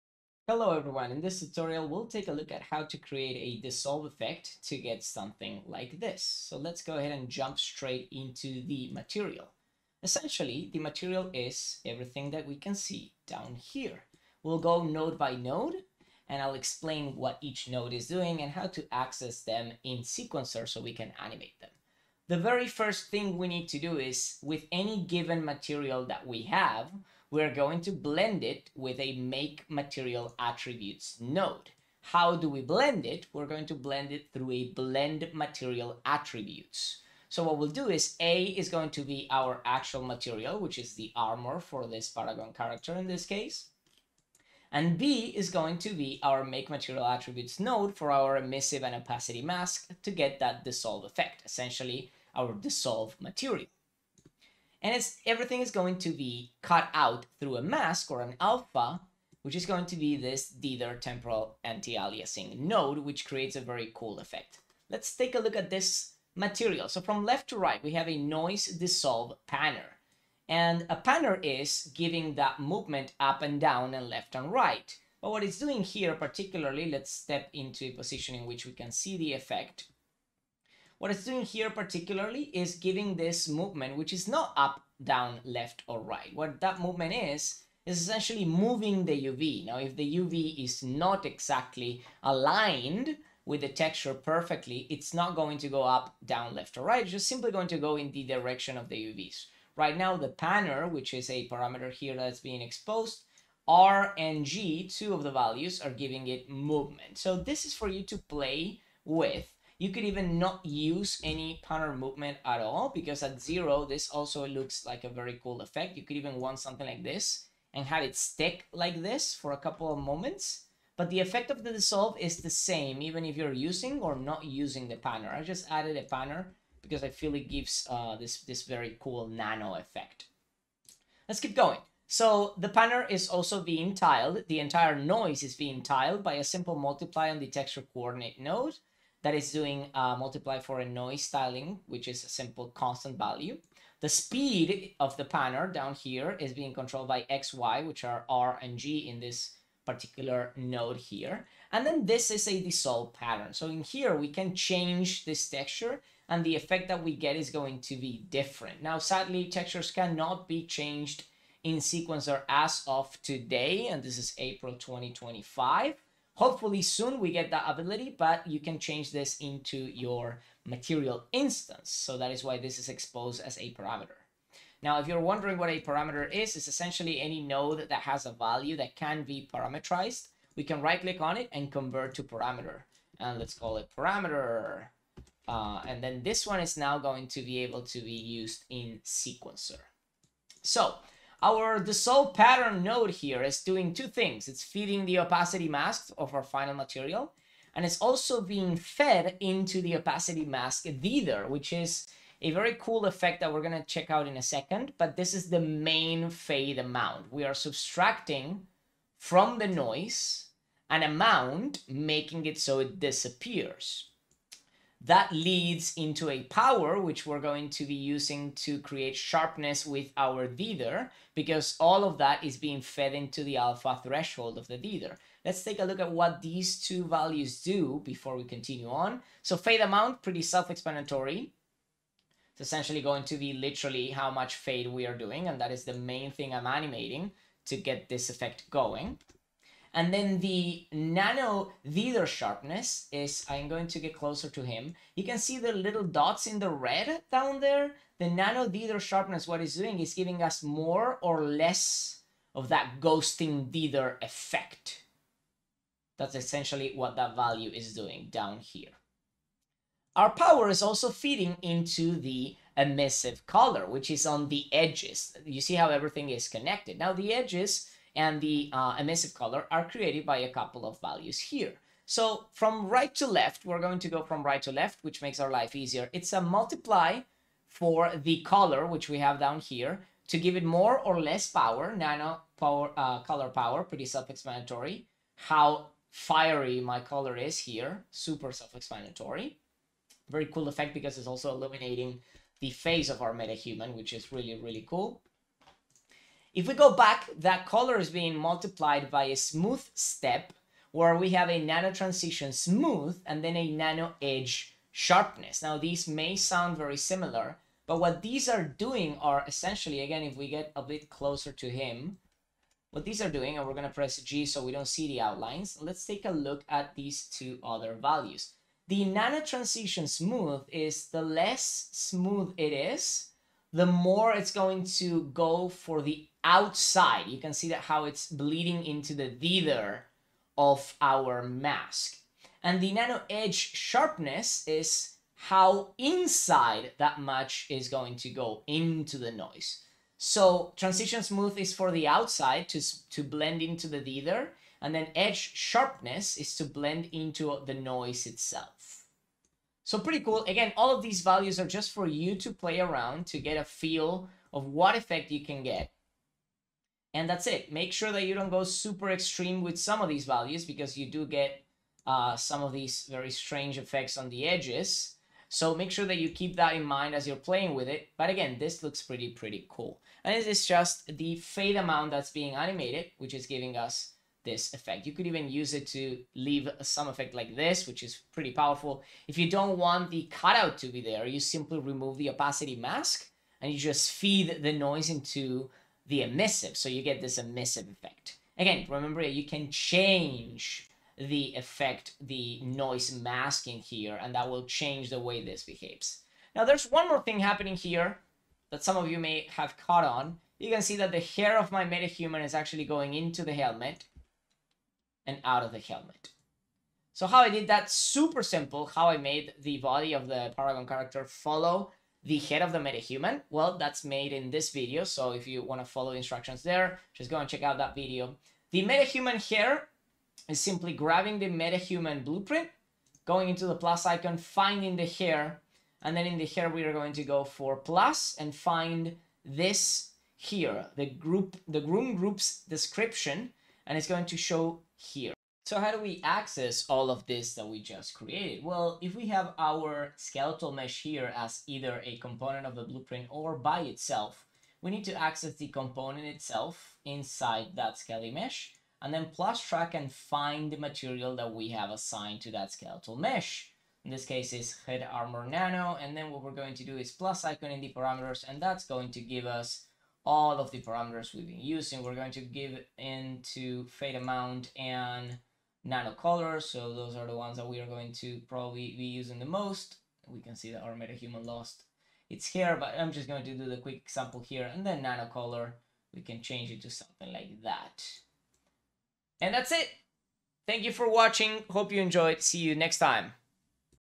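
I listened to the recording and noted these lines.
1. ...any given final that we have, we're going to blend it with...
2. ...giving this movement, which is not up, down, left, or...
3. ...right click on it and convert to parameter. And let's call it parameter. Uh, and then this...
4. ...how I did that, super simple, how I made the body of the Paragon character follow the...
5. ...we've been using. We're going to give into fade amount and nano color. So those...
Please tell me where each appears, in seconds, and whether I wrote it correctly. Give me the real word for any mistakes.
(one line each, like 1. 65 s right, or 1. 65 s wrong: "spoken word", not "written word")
1. 24 s wrong: "material", not "final"
2. 82 s right
3. 180 s right
4. 407 s right
5. 461 s right.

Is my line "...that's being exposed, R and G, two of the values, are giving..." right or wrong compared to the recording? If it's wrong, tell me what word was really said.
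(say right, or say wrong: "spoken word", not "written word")
right.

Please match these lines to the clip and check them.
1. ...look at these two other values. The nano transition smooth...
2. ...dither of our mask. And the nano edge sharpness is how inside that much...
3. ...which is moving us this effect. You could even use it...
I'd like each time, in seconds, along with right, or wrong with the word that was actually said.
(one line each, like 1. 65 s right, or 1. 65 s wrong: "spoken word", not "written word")
1. 316 s right
2. 329 s right
3. 373 s wrong: "giving", not "moving".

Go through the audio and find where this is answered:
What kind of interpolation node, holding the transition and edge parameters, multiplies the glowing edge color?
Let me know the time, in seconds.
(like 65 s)
299 s.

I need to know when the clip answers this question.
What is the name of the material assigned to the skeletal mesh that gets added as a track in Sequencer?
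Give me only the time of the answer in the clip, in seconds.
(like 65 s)
454 s.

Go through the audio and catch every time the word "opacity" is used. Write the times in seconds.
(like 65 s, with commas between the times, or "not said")
48 s, 195 s, 199 s, 382 s.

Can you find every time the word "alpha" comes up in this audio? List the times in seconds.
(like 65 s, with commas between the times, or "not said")
58 s, 223 s.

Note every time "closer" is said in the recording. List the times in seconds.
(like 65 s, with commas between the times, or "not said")
244 s, 311 s.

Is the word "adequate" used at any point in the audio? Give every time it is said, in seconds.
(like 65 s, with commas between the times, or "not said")
not said.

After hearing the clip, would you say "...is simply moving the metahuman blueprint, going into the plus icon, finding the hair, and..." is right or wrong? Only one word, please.
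wrong.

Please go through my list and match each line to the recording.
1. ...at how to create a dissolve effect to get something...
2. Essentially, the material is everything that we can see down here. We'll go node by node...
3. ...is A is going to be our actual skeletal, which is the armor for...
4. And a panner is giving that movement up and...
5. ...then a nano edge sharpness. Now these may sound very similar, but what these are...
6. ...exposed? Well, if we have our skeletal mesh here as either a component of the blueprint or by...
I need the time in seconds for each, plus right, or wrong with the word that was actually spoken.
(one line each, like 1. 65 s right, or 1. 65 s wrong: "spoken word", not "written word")
1. 2 s right
2. 10 s right
3. 37 s wrong: "material", not "skeletal"
4. 70 s right
5. 303 s right
6. 438 s wrong: "created", not "exposed".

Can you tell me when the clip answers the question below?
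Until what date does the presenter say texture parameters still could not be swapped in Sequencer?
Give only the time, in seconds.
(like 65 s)
164 s.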